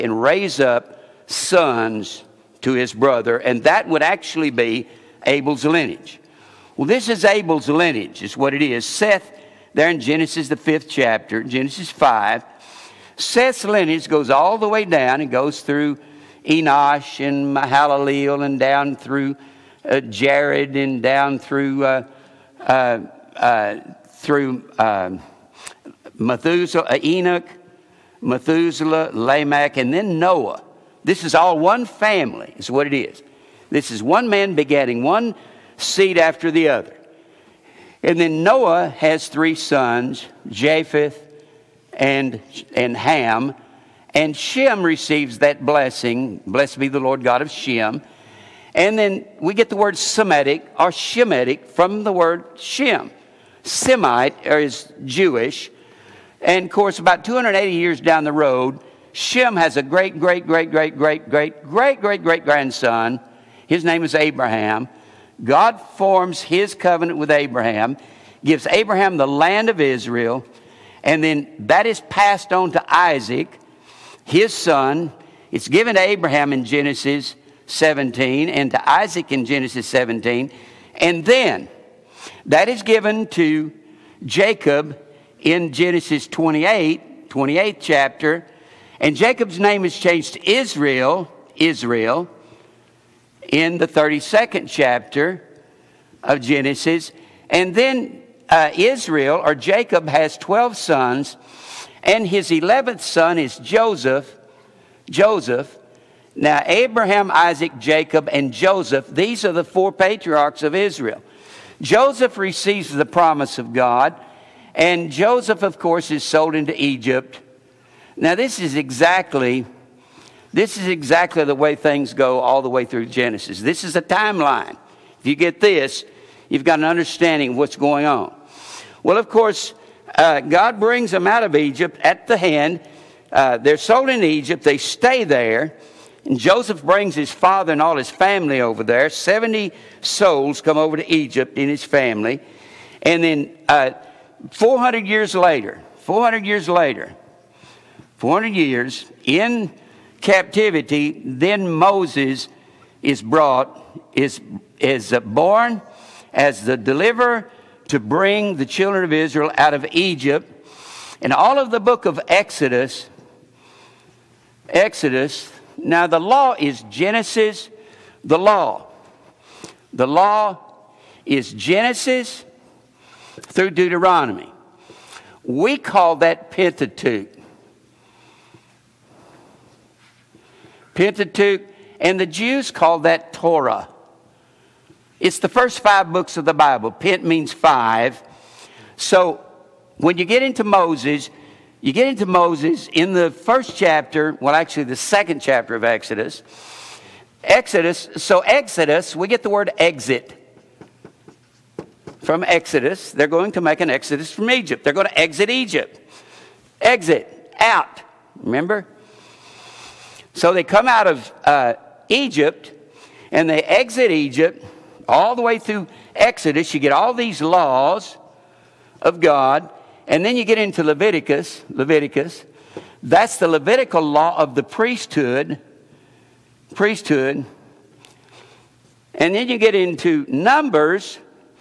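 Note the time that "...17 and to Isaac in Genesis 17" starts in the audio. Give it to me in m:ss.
1:17.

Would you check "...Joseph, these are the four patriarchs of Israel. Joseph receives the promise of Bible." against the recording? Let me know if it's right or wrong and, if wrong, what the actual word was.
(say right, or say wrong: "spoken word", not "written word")
wrong: "God", not "Bible".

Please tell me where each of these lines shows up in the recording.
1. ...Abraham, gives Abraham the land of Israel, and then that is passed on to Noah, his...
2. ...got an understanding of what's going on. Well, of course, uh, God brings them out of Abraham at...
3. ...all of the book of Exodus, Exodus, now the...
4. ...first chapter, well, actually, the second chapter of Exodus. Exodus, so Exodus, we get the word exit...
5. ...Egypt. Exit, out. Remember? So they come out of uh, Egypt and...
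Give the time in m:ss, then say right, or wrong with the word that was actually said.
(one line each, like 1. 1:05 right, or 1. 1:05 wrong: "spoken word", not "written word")
1. 1:07 wrong: "Isaac", not "Noah"
2. 2:06 wrong: "Egypt", not "Abraham"
3. 2:41 right
4. 3:13 right
5. 3:25 right.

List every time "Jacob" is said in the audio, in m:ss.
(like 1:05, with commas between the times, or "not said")
1:24, 1:29, 1:39, 1:47.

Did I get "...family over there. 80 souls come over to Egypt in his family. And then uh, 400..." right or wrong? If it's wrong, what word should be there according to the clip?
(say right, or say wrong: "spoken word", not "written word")
wrong: "70", not "80".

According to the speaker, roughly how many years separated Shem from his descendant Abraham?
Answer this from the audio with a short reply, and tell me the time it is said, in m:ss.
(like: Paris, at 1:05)
280, at 0:57.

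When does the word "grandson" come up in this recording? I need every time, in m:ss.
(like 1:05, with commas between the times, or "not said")
1:02.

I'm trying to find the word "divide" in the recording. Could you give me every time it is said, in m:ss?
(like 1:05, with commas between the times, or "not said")
not said.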